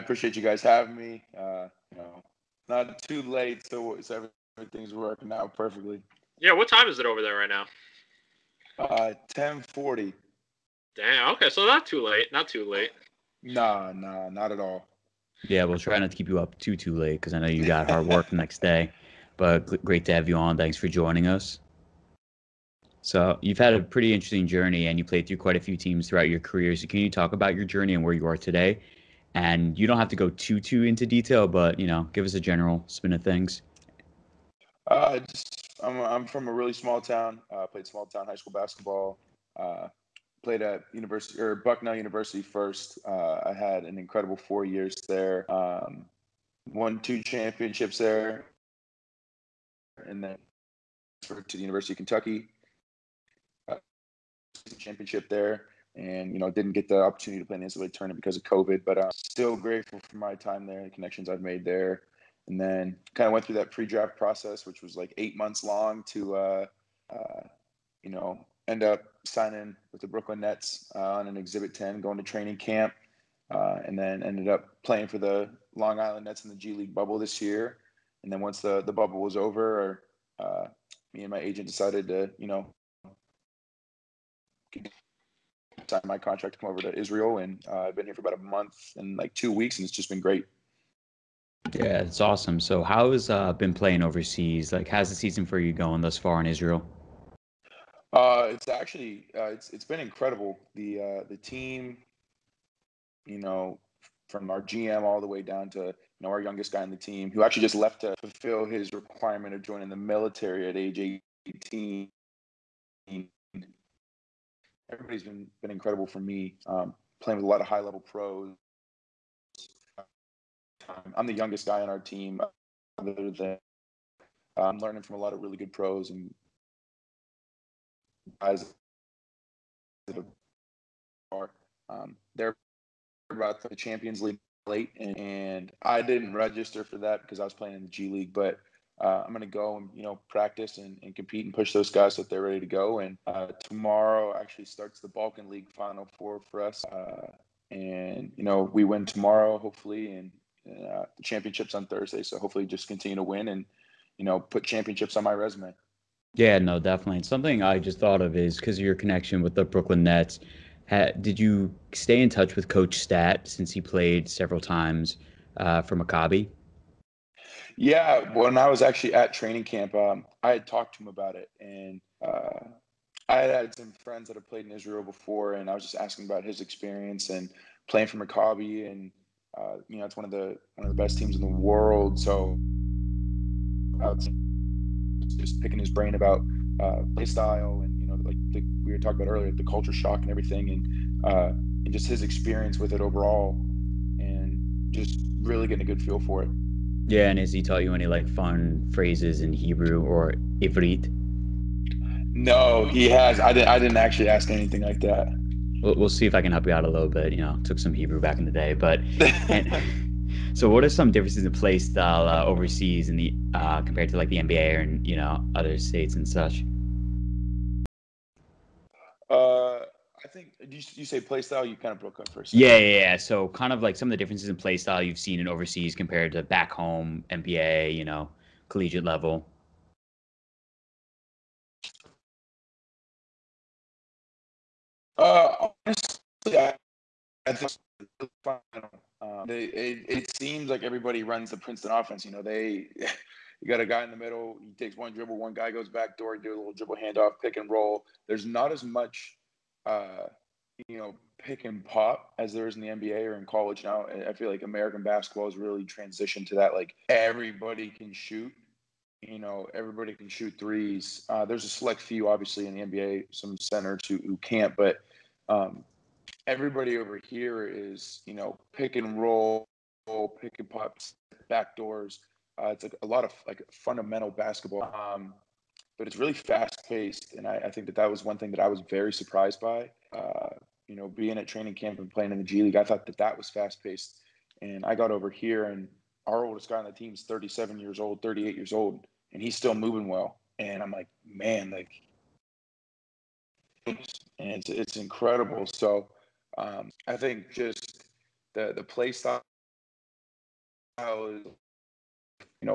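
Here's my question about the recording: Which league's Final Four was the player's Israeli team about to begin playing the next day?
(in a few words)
Balkan League.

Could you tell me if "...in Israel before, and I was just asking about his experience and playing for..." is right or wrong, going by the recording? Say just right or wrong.
right.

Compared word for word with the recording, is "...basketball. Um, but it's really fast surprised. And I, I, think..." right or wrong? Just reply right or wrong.
wrong.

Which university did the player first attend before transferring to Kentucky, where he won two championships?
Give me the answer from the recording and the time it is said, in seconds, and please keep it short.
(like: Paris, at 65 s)
Bucknell University, at 41 s.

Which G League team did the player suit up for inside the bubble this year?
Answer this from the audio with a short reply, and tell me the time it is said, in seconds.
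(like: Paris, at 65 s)
Long Island Nets, at 75 s.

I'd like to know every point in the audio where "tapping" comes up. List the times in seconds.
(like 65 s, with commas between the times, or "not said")
not said.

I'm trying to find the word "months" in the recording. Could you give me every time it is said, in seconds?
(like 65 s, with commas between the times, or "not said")
65 s, 88 s.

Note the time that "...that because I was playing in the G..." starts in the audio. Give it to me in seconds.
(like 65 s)
136 s.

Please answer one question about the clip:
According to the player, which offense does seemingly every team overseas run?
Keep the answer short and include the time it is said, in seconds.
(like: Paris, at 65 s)
Princeton offense, at 241 s.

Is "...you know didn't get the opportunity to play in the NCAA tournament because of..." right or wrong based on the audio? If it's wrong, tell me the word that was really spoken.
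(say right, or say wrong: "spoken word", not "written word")
right.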